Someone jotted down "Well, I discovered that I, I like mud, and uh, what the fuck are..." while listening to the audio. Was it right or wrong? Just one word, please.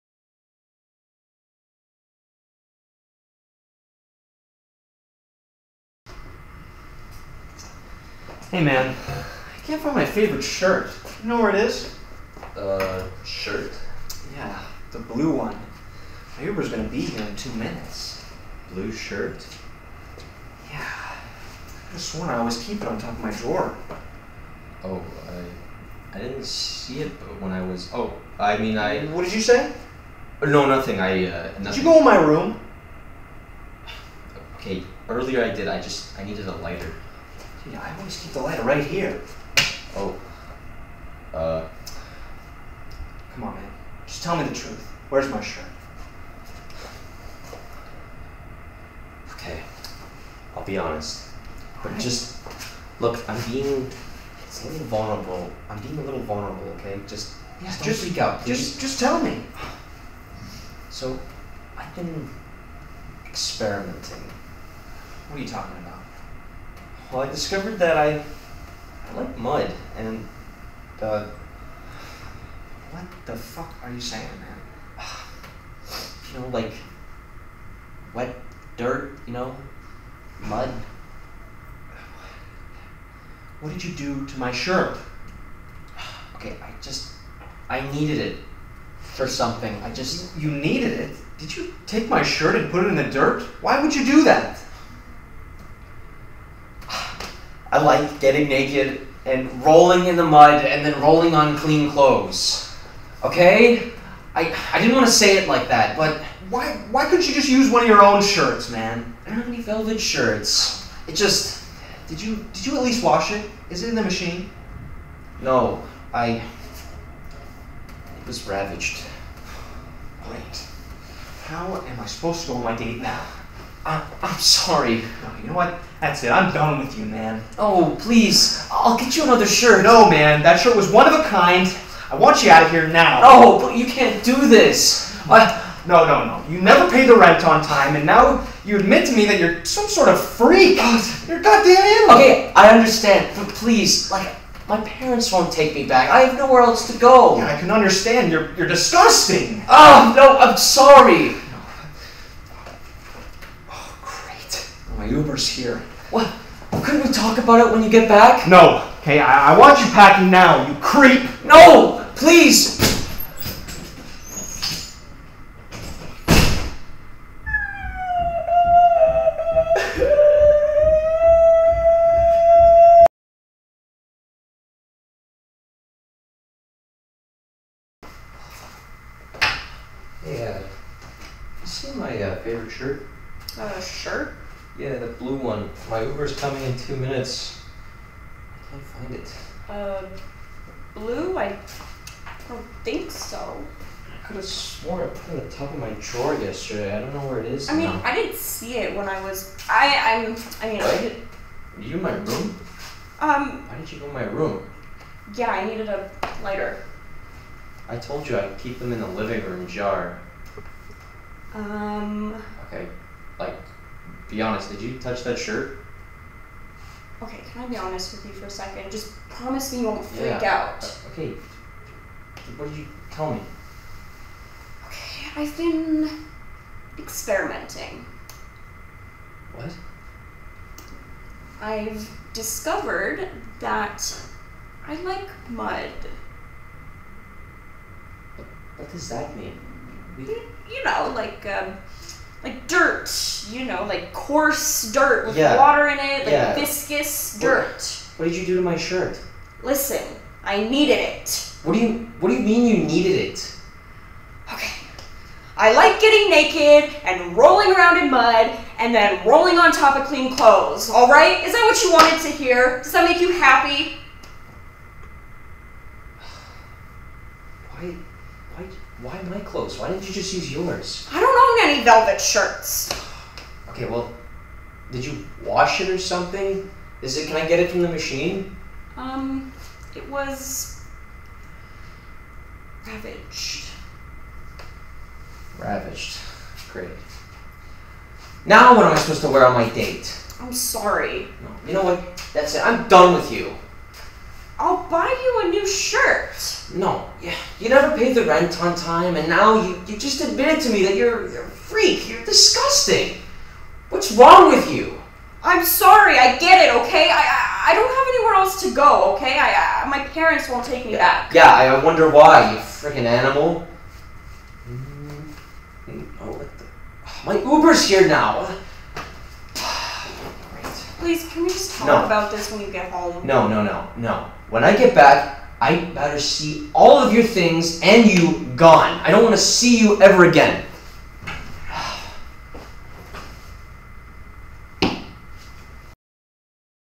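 right.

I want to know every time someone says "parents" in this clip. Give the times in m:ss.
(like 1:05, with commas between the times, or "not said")
2:24, 5:10.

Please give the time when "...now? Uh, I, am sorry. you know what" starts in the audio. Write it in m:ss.
2:03.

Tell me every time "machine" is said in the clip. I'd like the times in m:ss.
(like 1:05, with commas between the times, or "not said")
1:54, 4:37.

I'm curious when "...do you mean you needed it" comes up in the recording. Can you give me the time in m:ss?
4:12.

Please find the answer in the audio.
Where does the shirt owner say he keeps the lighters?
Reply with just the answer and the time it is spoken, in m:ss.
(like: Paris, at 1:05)
living room jar, at 3:29.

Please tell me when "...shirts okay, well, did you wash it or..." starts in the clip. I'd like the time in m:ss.
4:32.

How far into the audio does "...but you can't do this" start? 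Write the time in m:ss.
2:13.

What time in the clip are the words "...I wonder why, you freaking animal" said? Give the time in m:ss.
5:11.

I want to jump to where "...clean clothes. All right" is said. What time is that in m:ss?
4:20.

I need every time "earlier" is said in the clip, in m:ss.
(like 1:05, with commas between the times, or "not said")
0:35.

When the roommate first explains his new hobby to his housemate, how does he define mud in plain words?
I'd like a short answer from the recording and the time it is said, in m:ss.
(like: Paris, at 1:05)
wet dirt, at 1:18.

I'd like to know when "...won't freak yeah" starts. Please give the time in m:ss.
3:39.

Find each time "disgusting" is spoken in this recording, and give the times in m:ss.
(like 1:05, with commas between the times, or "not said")
2:28, 5:02.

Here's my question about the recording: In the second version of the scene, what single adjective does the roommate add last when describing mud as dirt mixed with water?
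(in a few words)
viscous.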